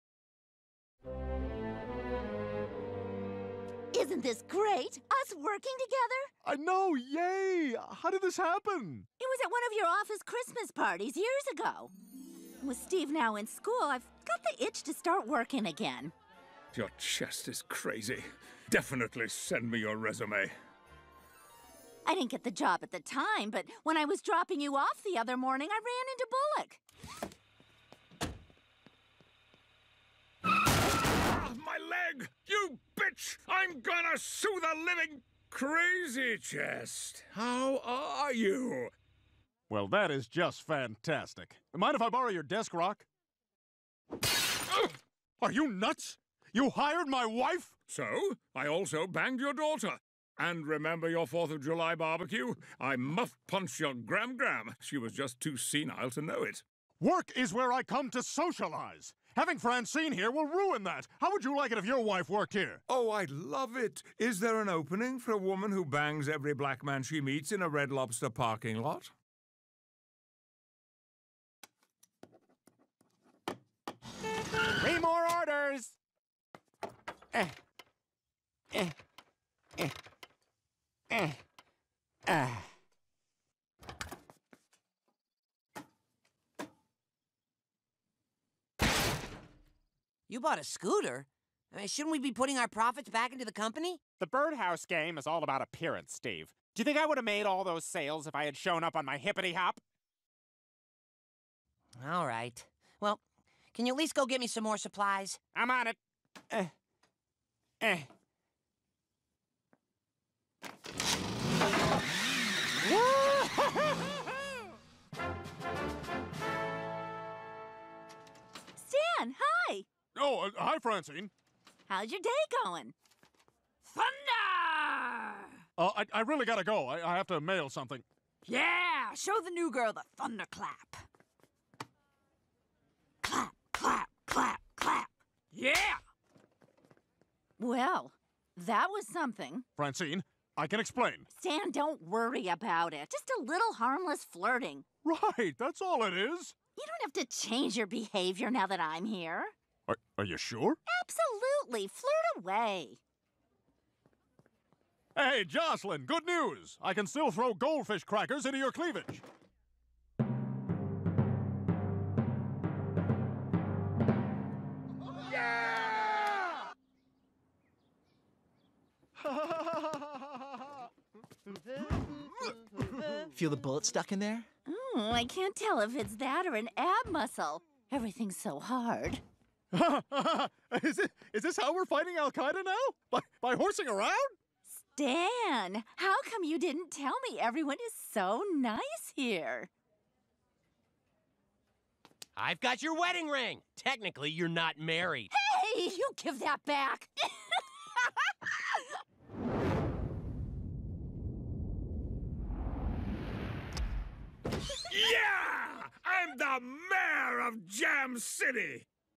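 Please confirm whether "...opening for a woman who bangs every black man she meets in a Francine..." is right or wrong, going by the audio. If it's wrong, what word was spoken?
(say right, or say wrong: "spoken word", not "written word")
wrong: "Red", not "Francine".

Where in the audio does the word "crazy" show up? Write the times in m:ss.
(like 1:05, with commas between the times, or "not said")
0:17, 0:35.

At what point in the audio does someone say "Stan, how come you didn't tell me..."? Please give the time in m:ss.
3:04.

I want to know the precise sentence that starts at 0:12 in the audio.
With Steve now in school, I've got the itch to start working again.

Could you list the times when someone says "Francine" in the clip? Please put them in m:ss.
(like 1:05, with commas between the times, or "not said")
0:59, 2:00, 2:19.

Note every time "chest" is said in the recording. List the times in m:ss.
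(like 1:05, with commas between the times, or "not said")
0:16, 0:36.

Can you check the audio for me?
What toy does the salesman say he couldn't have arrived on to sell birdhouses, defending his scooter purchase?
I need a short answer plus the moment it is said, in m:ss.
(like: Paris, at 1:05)
Hippity hop, at 1:39.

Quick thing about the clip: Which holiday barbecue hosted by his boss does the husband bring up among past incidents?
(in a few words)
4th of July.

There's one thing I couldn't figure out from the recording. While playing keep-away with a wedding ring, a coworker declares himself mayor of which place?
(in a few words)
Jam City.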